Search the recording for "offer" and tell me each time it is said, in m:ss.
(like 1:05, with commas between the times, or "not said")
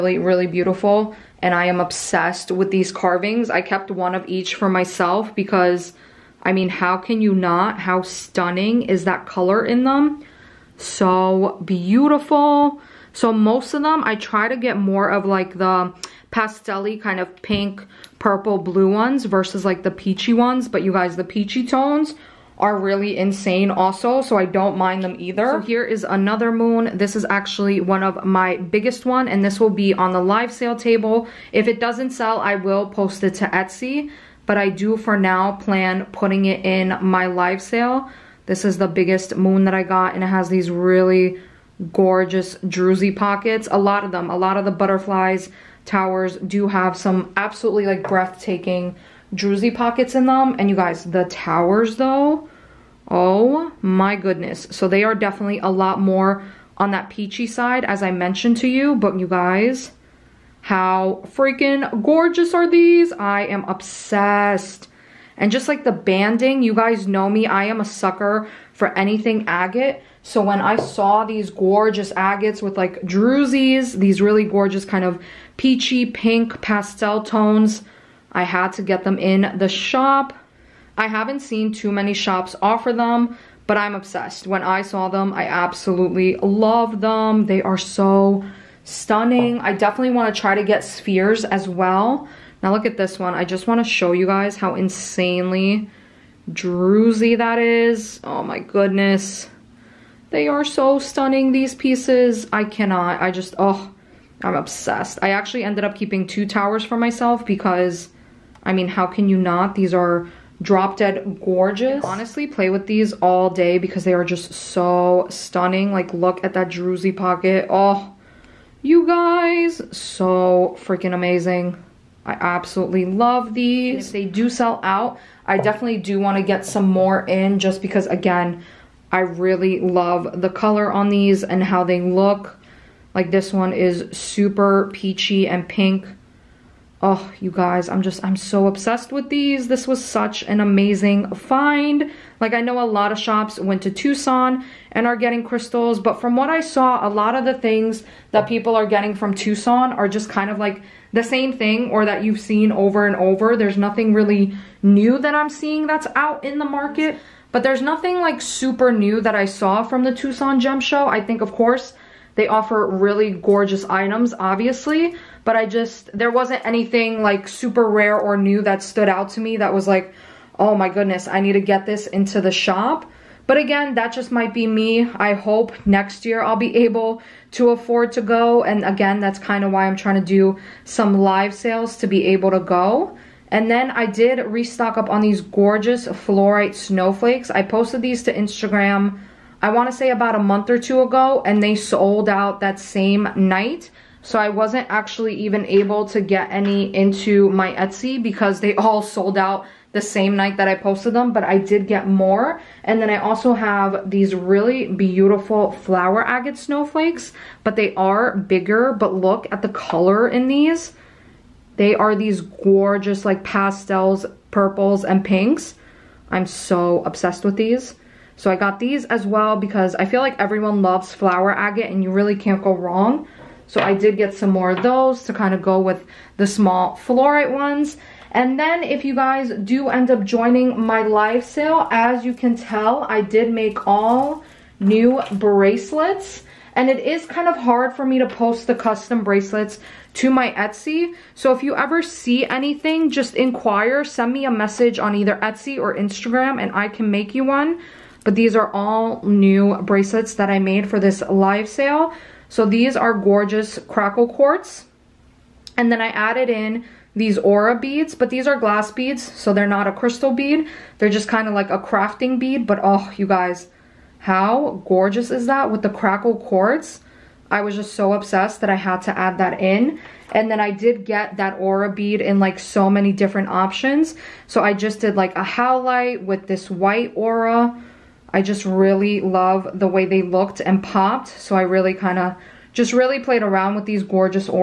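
1:22, 2:42.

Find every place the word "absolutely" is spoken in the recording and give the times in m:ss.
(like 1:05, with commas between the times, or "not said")
0:47, 1:25, 2:02.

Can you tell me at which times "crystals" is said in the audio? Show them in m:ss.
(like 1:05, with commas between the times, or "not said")
2:25, 4:19.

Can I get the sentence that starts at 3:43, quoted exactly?
So I did get some more of those to kind of go with the small fluorite ones.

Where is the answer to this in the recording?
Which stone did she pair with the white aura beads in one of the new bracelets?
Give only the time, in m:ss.
4:35.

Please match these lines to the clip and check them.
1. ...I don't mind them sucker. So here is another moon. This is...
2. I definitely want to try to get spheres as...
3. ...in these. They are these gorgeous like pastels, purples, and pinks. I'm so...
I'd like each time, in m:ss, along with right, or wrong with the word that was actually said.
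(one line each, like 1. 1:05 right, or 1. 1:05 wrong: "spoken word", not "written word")
1. 0:24 wrong: "either", not "sucker"
2. 1:29 right
3. 3:30 right.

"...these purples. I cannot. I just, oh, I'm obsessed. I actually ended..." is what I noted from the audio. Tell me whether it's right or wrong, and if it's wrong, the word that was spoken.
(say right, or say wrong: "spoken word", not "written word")
wrong: "pieces", not "purples".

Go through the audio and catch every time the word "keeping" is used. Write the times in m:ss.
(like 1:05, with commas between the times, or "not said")
1:45.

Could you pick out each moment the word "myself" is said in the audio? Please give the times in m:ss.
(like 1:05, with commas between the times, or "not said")
0:04, 1:46.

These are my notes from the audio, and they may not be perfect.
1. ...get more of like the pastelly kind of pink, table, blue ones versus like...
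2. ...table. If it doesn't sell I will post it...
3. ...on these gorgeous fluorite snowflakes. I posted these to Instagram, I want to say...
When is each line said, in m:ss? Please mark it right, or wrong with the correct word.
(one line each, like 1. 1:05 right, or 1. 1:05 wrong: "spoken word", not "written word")
1. 0:14 wrong: "purple", not "table"
2. 0:30 right
3. 3:05 right.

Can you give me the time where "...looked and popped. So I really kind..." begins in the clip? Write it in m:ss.
4:40.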